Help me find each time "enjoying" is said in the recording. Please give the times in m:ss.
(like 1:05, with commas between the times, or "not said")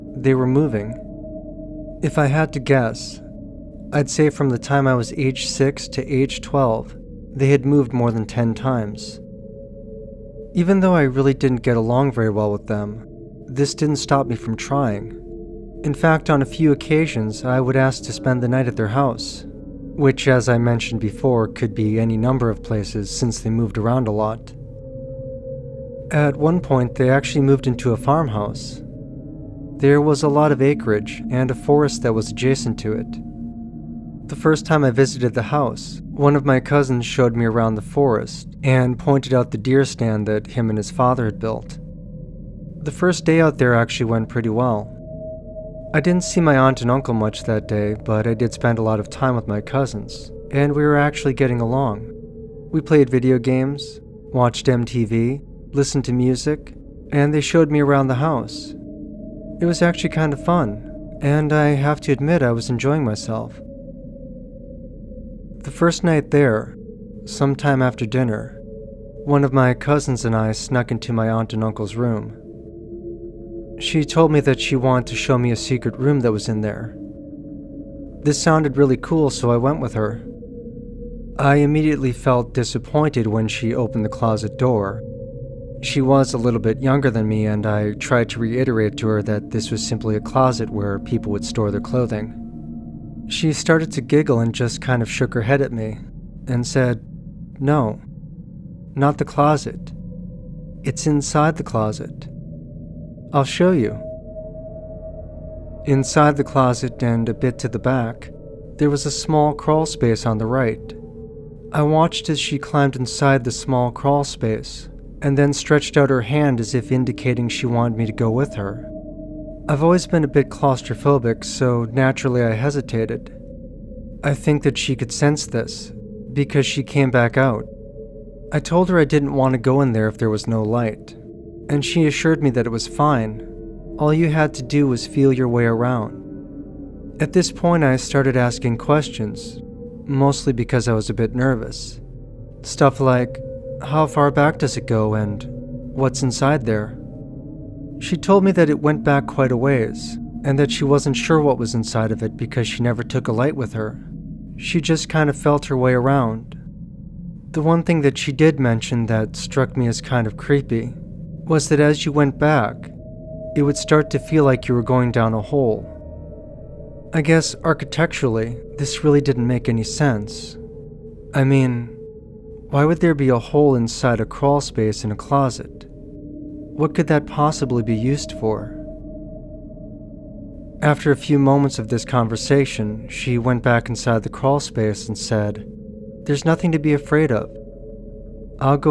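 1:02.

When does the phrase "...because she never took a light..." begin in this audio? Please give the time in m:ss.
2:32.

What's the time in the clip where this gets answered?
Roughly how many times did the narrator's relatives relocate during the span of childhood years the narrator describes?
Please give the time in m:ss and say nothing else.
0:07.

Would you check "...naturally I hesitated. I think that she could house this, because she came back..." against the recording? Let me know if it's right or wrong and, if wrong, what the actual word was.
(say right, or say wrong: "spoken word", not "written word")
wrong: "sense", not "house".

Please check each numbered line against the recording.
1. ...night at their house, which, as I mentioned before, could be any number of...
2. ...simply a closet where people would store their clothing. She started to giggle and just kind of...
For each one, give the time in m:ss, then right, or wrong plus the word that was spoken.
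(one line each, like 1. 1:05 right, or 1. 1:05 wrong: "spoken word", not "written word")
1. 0:18 right
2. 1:29 right.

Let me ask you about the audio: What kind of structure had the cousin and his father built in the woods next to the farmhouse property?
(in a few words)
deer stand.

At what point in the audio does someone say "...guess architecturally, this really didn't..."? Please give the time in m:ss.
2:47.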